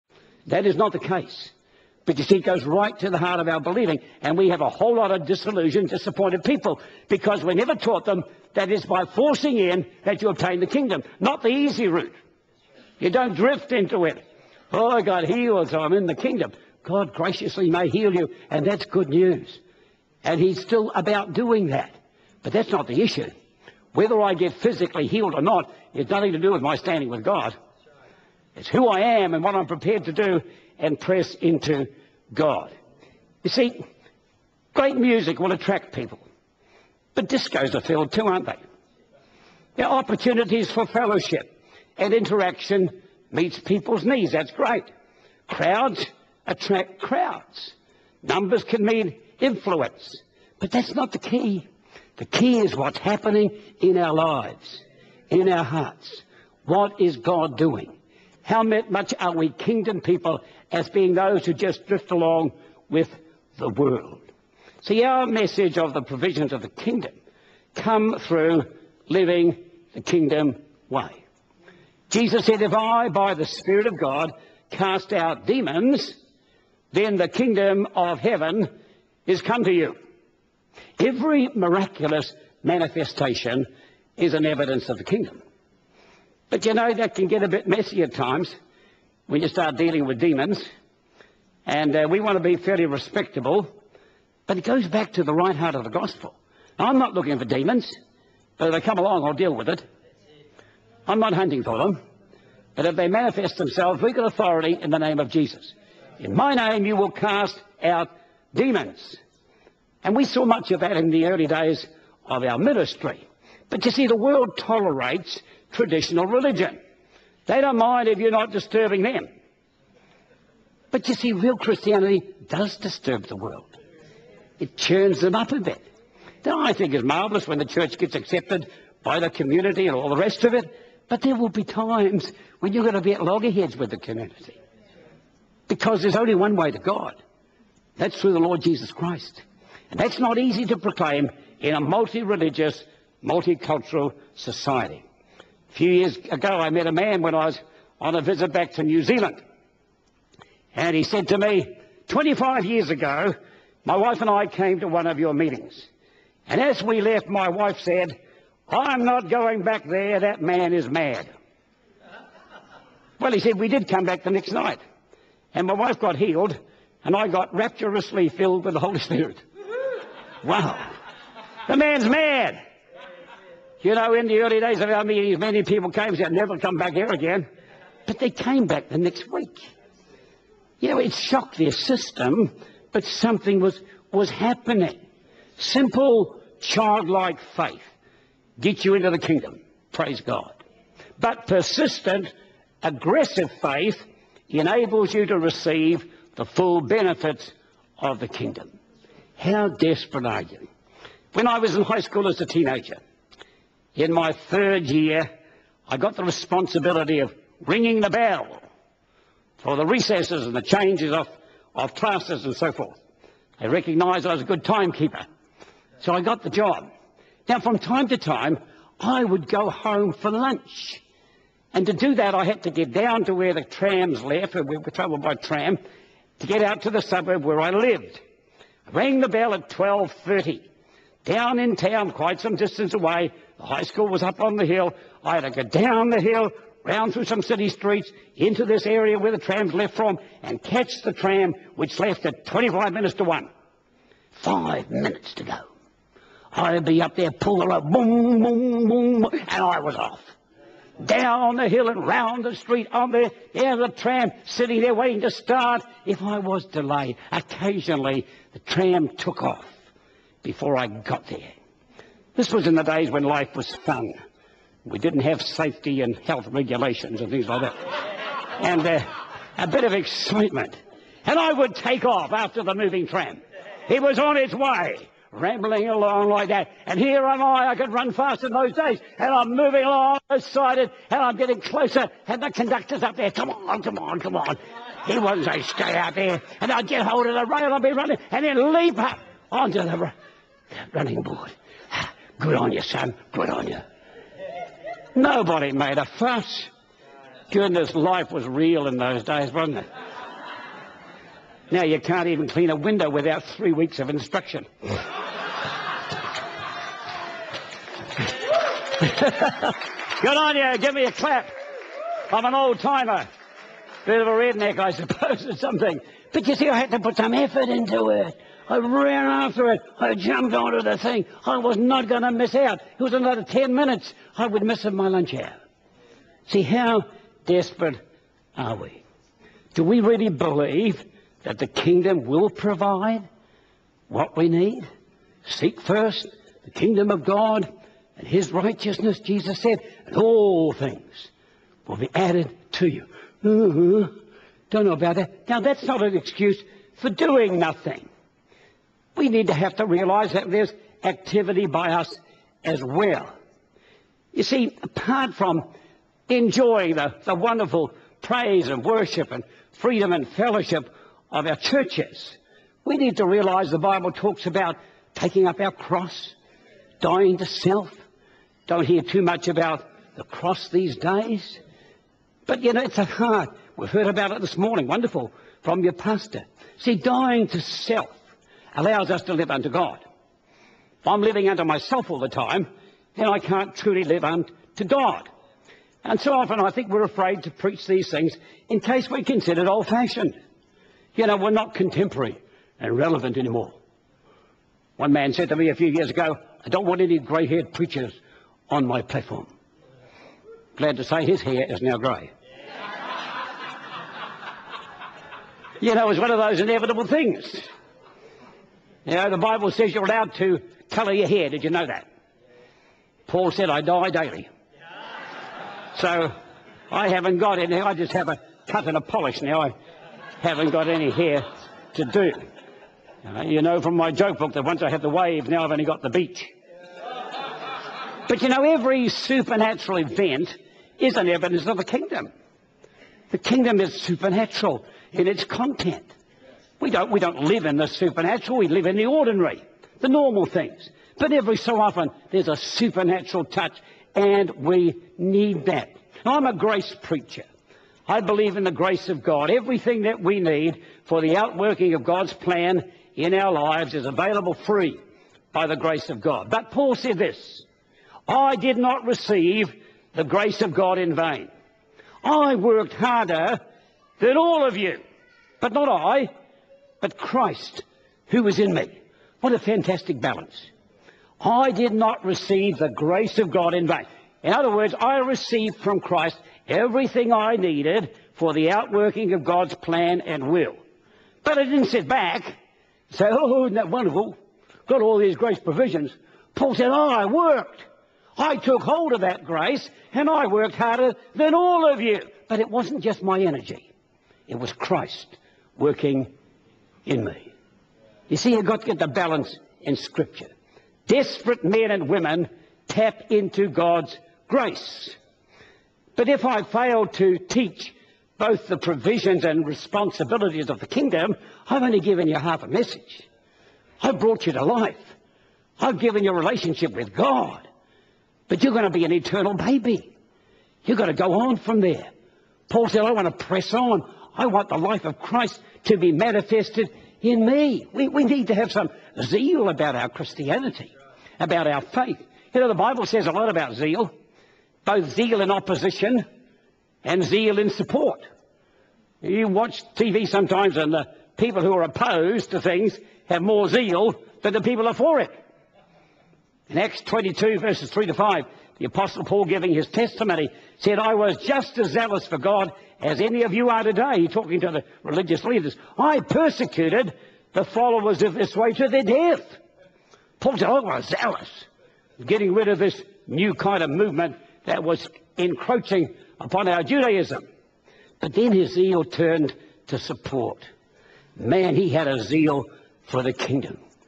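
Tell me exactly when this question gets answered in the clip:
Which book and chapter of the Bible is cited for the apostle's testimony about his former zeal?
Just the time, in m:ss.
9:06.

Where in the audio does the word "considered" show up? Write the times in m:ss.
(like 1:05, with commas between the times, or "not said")
6:29.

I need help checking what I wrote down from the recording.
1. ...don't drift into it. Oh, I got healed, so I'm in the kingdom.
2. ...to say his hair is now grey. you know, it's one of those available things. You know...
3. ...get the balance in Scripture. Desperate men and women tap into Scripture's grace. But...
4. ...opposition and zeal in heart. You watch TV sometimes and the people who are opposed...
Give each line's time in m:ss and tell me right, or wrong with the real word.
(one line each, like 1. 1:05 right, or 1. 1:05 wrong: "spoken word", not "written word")
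1. 0:13 right
2. 6:40 wrong: "inevitable", not "available"
3. 8:18 wrong: "God", not "Scripture"
4. 8:55 wrong: "support", not "heart".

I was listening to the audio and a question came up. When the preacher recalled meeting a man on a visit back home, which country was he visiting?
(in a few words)
New Zealand.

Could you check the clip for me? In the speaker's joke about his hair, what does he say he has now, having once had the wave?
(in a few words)
the beach.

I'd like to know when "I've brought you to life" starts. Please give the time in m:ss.
8:34.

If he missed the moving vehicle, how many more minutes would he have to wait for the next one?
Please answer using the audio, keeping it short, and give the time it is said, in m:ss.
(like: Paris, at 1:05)
10, at 5:23.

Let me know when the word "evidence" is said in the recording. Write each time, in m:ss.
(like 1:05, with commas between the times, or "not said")
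1:24, 7:11.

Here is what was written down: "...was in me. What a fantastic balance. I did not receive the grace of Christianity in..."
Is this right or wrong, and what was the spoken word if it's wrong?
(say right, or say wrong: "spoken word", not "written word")
wrong: "God", not "Christianity".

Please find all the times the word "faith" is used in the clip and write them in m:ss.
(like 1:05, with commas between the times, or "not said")
3:07, 3:13, 8:51.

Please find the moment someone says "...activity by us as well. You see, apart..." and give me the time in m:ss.
5:51.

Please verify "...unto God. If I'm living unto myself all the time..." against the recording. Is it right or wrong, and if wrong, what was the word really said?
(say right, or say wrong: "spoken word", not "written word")
right.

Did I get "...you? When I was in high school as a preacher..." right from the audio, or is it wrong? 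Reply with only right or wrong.
wrong.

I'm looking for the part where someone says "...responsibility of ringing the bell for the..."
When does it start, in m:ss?
3:26.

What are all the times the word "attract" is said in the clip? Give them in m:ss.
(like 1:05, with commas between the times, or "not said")
0:35, 0:46.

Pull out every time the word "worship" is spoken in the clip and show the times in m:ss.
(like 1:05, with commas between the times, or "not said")
5:58.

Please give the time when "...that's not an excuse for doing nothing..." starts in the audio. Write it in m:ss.
5:45.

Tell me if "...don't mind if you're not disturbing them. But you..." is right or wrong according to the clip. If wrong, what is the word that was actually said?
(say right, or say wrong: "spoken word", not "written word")
right.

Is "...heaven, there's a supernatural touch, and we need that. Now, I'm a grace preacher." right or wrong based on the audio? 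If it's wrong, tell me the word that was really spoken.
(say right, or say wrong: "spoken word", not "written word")
wrong: "often", not "heaven".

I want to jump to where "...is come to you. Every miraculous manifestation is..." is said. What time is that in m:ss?
1:19.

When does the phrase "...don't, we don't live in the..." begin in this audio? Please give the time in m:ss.
7:16.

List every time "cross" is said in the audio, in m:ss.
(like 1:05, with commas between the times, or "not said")
6:05, 6:10.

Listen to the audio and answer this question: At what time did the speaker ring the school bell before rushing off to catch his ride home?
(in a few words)
12.30.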